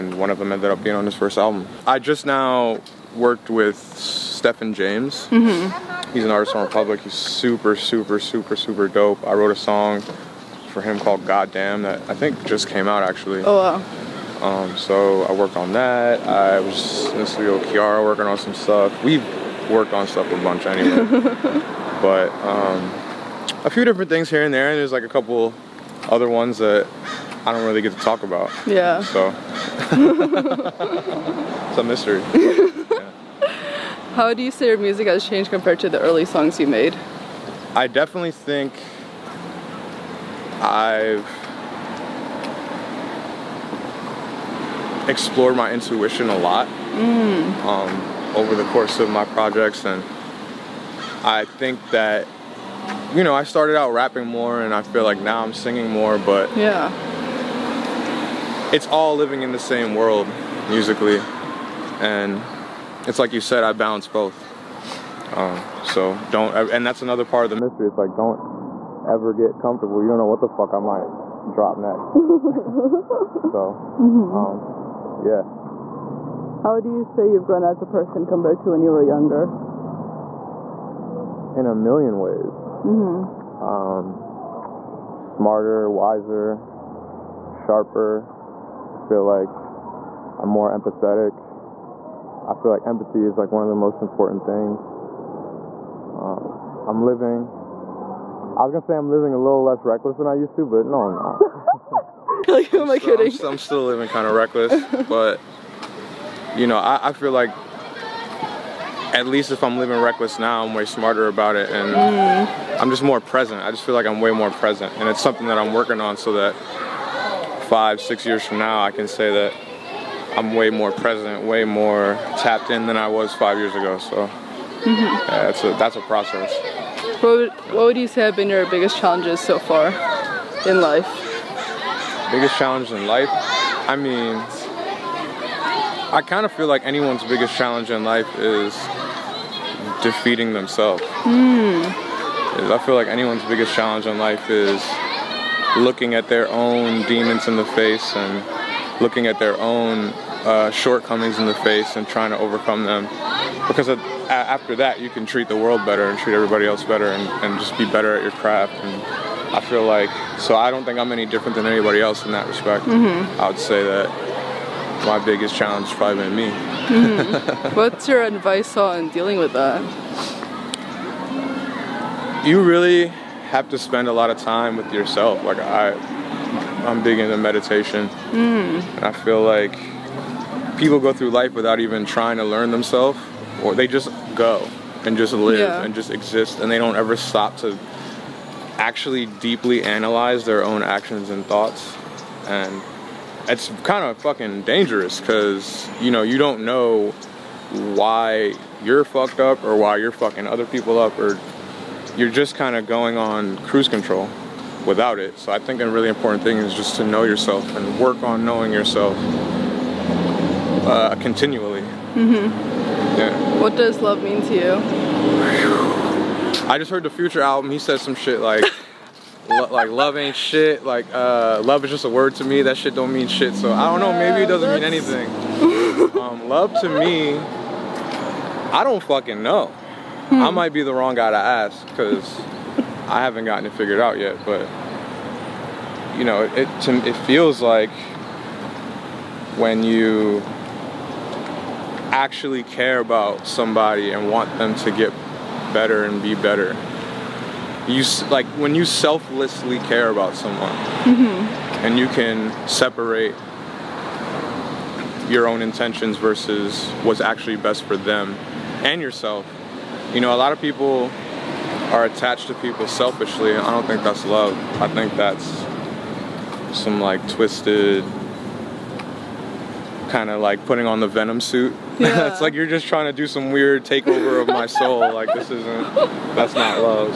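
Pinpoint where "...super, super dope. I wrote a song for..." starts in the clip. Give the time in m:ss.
0:08.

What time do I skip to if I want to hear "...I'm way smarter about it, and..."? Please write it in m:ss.
1:50.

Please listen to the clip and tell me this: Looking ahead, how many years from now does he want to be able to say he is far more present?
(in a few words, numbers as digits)
5 or 6 years.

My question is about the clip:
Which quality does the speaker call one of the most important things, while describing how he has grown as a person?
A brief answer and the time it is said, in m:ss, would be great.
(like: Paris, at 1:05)
empathy, at 1:32.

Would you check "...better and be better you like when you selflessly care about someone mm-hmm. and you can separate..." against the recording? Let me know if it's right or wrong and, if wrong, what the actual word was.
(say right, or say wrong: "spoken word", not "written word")
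right.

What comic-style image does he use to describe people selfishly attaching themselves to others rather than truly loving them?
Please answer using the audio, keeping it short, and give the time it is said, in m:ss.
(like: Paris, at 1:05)
putting on the venom suit, at 4:30.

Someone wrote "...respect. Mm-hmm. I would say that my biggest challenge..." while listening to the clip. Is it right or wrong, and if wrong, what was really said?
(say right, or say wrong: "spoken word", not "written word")
right.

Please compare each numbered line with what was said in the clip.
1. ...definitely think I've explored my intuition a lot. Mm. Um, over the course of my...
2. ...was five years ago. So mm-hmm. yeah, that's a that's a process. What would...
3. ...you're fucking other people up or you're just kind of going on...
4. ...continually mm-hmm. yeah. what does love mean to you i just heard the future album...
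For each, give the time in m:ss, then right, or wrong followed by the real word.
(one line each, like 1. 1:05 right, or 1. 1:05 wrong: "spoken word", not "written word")
1. 0:37 right
2. 2:03 right
3. 3:19 right
4. 3:31 right.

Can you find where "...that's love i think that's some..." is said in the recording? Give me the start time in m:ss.
4:24.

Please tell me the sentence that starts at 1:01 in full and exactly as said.
And it's like you said, I balance both.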